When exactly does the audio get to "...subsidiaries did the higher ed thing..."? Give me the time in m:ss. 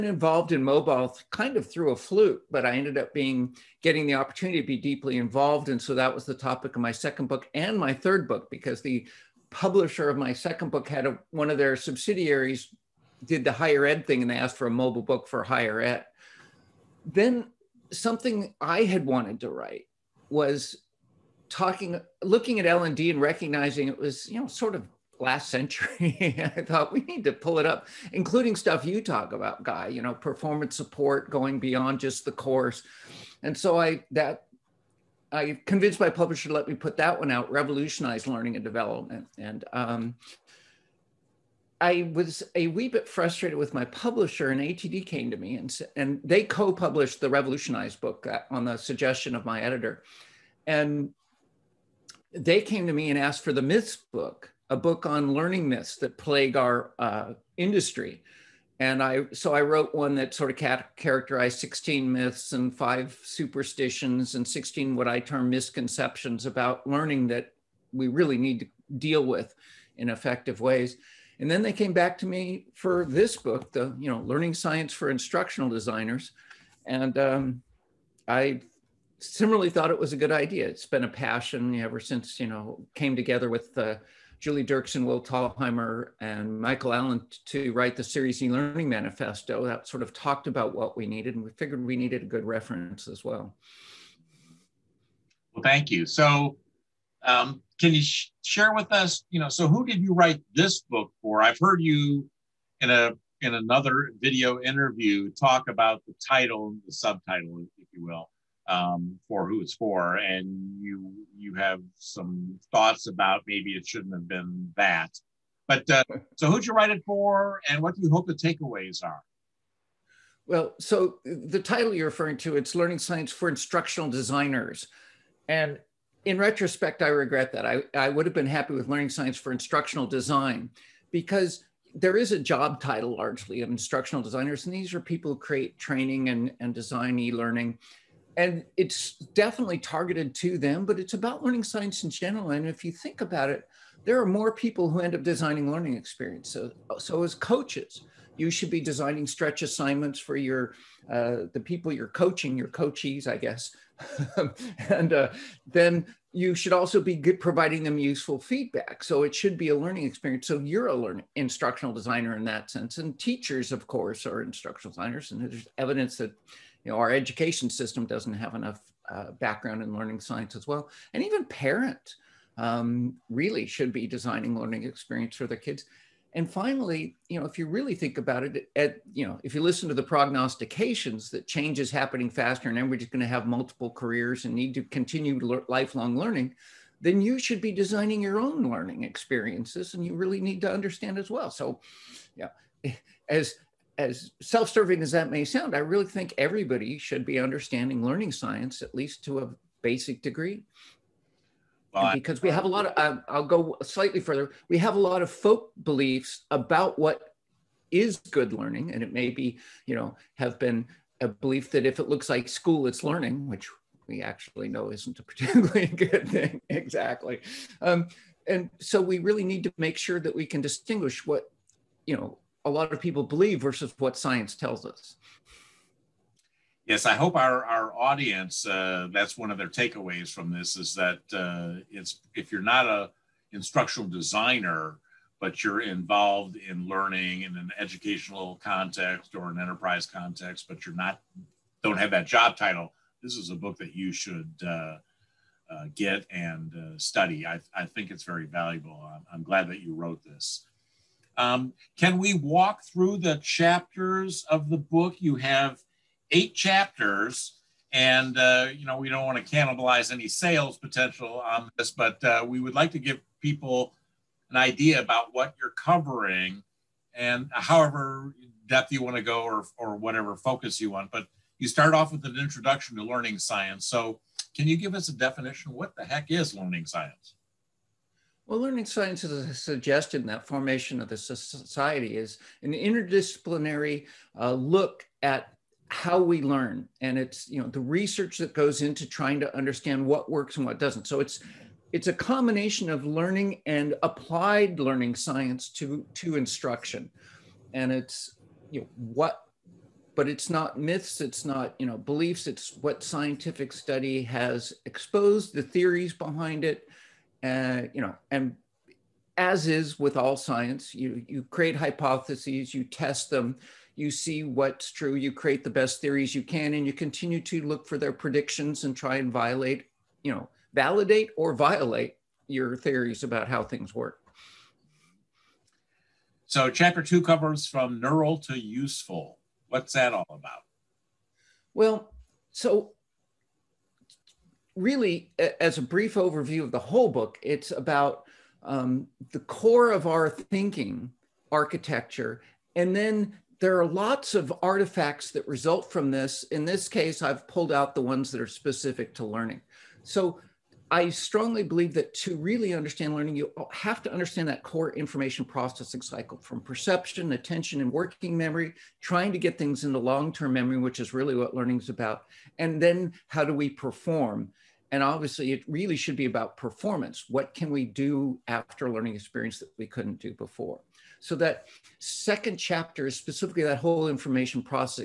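0:11.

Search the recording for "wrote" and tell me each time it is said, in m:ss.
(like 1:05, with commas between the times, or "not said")
0:59, 4:09.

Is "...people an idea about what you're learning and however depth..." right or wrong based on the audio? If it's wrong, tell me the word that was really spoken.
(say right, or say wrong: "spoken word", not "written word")
wrong: "covering", not "learning".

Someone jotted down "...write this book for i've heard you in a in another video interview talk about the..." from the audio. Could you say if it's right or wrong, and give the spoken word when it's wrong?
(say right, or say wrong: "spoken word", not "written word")
right.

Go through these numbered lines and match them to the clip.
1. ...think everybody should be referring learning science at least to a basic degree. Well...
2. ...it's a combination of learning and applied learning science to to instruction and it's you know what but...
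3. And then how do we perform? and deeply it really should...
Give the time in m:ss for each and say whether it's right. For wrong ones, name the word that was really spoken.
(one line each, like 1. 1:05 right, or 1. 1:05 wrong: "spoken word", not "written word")
1. 3:16 wrong: "understanding", not "referring"
2. 4:51 right
3. 6:02 wrong: "obviously", not "deeply".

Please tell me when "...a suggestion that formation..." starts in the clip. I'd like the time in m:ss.
4:39.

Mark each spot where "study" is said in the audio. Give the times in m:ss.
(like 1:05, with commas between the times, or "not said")
4:06, 5:03.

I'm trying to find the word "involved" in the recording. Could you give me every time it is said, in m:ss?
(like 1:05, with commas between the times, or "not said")
0:00, 0:05, 3:55.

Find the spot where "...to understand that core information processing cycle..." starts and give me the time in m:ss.
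5:54.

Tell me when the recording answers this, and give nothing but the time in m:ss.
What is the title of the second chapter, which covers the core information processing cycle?
5:27.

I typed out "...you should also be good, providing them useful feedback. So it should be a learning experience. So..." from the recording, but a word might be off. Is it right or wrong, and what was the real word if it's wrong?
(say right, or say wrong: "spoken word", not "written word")
right.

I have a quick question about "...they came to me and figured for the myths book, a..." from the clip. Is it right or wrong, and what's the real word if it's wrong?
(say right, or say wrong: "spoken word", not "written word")
wrong: "asked", not "figured".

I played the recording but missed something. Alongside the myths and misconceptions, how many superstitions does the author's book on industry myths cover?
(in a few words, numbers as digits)
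5.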